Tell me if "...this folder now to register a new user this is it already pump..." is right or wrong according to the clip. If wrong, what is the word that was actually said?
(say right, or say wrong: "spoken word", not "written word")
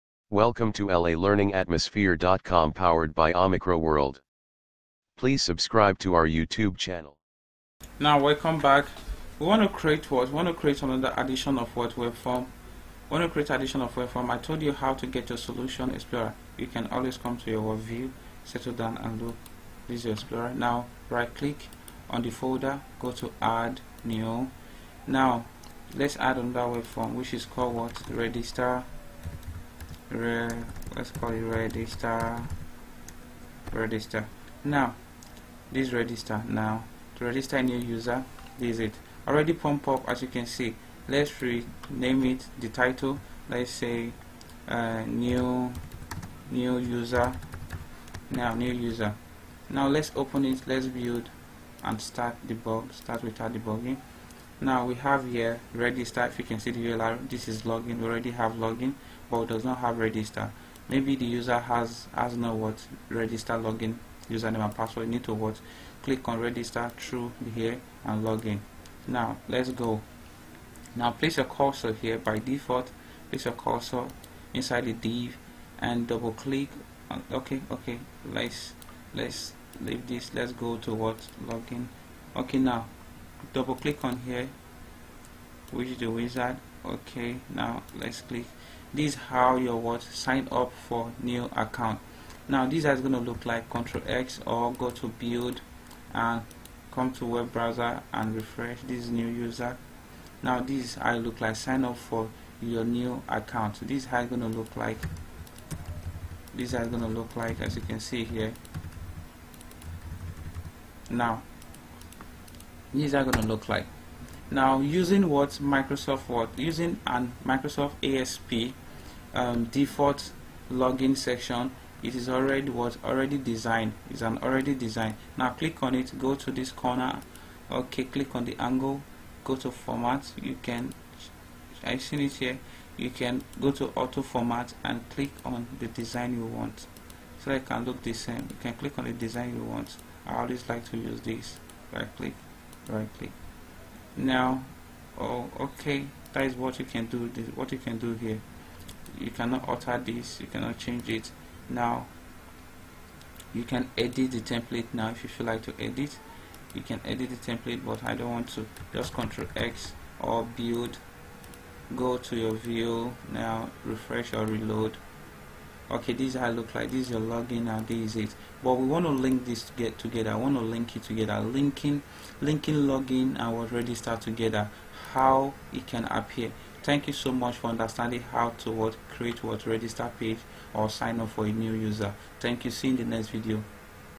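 wrong: "register", not "folder".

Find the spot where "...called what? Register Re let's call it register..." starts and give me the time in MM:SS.
00:27.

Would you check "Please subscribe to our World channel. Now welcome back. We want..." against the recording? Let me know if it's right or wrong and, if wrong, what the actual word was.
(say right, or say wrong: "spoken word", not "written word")
wrong: "YouTube", not "World".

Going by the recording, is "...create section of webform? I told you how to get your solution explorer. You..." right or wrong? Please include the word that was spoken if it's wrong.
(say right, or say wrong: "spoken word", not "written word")
wrong: "addition", not "section".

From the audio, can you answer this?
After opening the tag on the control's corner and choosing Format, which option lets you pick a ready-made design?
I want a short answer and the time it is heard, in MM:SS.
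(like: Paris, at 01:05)
Auto format, at 02:13.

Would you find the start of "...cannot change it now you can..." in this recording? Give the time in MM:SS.
02:30.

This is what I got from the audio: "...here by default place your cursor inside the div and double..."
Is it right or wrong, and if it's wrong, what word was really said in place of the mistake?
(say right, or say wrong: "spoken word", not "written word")
right.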